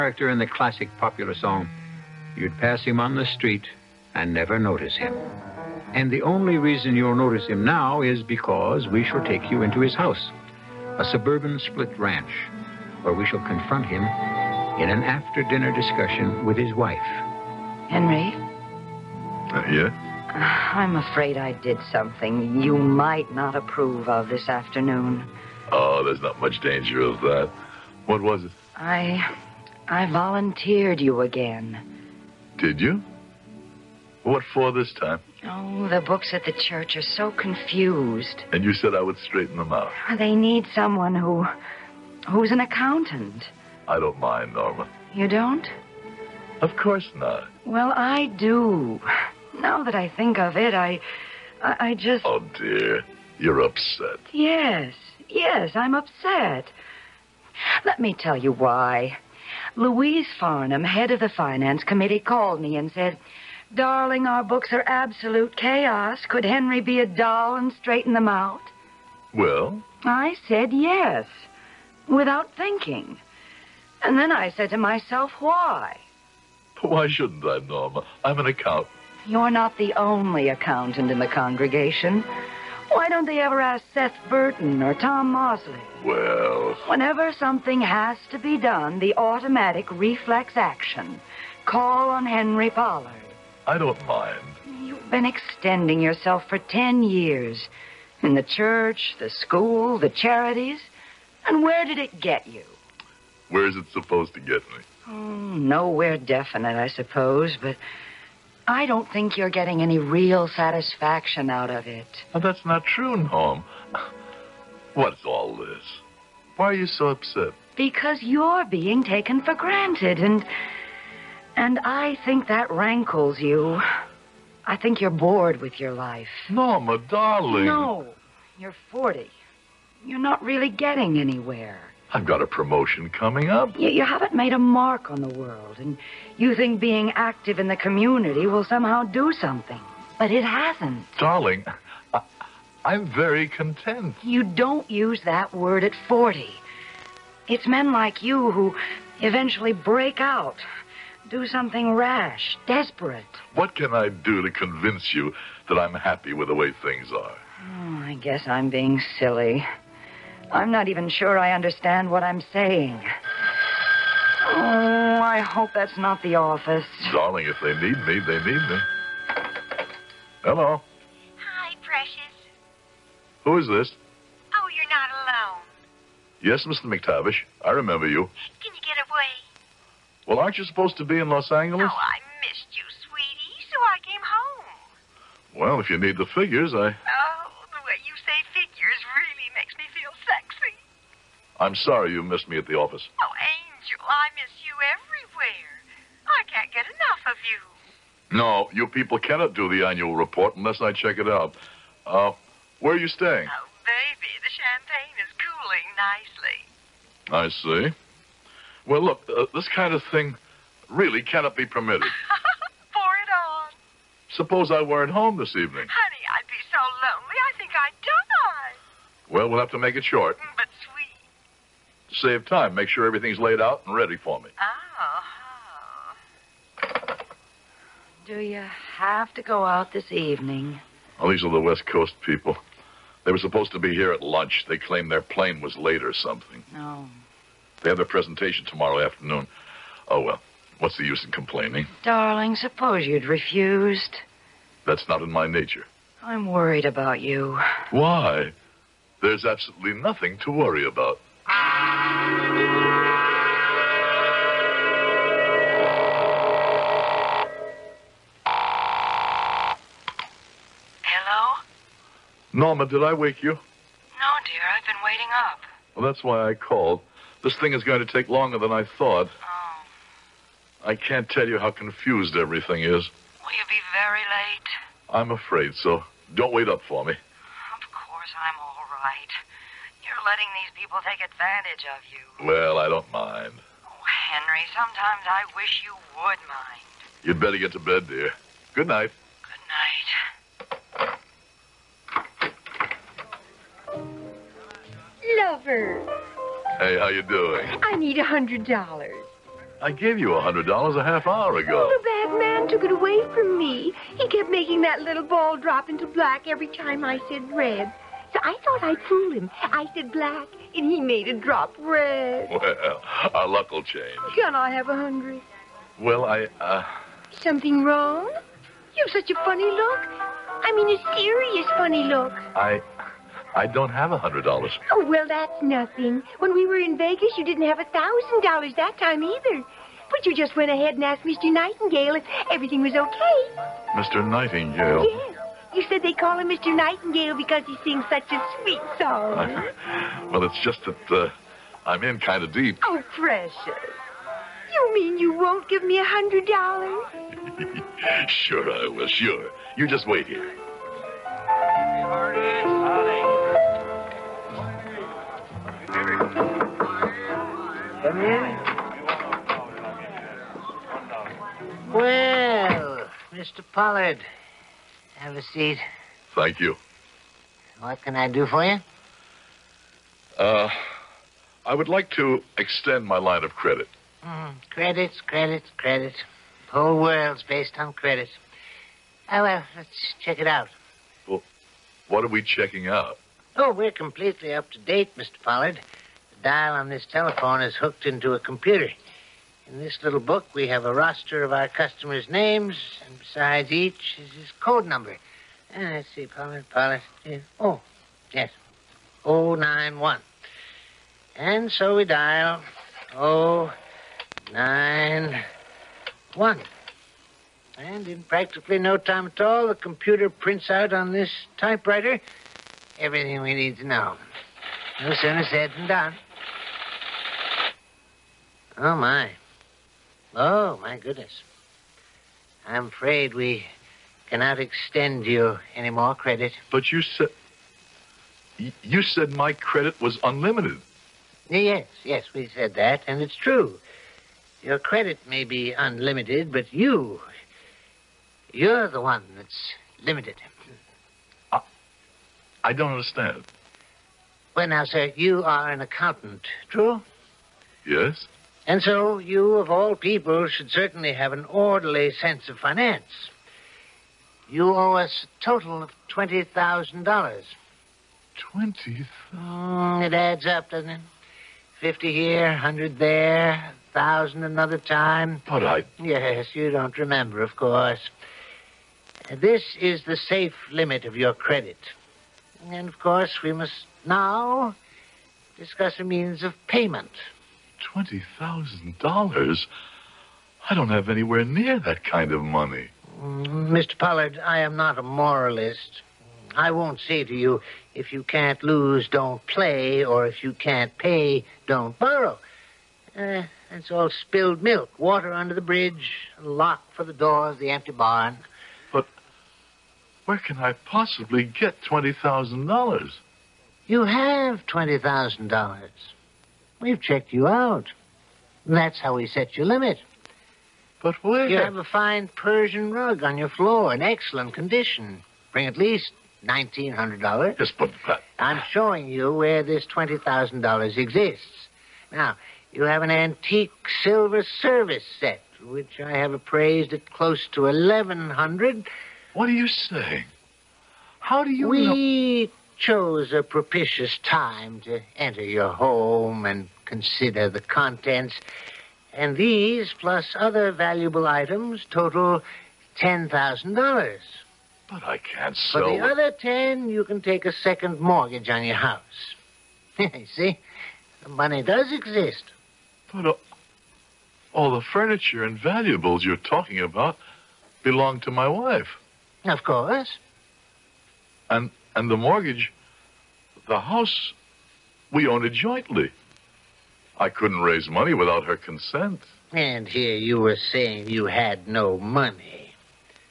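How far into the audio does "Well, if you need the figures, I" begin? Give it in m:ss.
3:05.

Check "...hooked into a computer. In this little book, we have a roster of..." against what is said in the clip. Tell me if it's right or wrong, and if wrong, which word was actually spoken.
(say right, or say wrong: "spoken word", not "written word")
right.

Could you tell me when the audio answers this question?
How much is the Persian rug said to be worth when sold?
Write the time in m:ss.
8:36.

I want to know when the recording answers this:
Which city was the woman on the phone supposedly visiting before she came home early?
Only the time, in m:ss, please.
3:01.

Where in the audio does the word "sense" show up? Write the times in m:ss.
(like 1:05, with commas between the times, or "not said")
7:32.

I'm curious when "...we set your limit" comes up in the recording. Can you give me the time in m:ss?
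8:29.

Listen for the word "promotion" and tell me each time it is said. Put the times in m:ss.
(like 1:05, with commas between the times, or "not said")
2:12.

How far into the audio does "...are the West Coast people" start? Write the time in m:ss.
3:51.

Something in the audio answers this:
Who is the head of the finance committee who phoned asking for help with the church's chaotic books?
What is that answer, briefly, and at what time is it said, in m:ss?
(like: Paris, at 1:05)
Louise Farnham, at 0:59.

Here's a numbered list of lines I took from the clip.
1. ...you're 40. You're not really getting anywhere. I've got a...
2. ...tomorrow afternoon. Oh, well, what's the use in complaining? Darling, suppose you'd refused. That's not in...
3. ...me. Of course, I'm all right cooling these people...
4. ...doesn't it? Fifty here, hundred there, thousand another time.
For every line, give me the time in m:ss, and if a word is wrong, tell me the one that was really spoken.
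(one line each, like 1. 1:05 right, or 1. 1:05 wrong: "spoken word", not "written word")
1. 2:08 right
2. 3:58 right
3. 4:37 wrong: "letting", not "cooling"
4. 7:40 right.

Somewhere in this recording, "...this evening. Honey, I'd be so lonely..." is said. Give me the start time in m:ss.
3:35.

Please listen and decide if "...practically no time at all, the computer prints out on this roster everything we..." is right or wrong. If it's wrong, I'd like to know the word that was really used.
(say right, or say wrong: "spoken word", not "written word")
wrong: "typewriter", not "roster".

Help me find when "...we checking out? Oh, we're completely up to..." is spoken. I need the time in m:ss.
6:22.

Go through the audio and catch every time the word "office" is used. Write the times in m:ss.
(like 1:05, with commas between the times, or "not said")
2:46, 3:12.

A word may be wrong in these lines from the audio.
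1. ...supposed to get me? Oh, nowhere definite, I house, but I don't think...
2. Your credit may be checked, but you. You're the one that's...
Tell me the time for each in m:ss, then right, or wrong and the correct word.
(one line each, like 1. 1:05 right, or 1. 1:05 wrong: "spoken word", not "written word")
1. 1:43 wrong: "suppose", not "house"
2. 7:14 wrong: "unlimited", not "checked".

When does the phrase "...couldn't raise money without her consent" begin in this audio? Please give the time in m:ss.
9:27.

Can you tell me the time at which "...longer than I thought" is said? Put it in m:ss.
4:28.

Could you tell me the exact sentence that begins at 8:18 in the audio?
But where can I possibly get $20,000?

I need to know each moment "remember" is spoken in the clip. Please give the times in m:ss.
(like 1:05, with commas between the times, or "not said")
2:57, 7:46.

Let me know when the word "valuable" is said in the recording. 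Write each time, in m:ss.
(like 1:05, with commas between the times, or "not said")
9:00, 9:15.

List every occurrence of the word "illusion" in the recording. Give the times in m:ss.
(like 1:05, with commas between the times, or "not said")
not said.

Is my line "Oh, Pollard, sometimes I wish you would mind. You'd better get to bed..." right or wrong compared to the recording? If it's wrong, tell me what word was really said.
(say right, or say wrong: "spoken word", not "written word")
wrong: "Henry", not "Pollard".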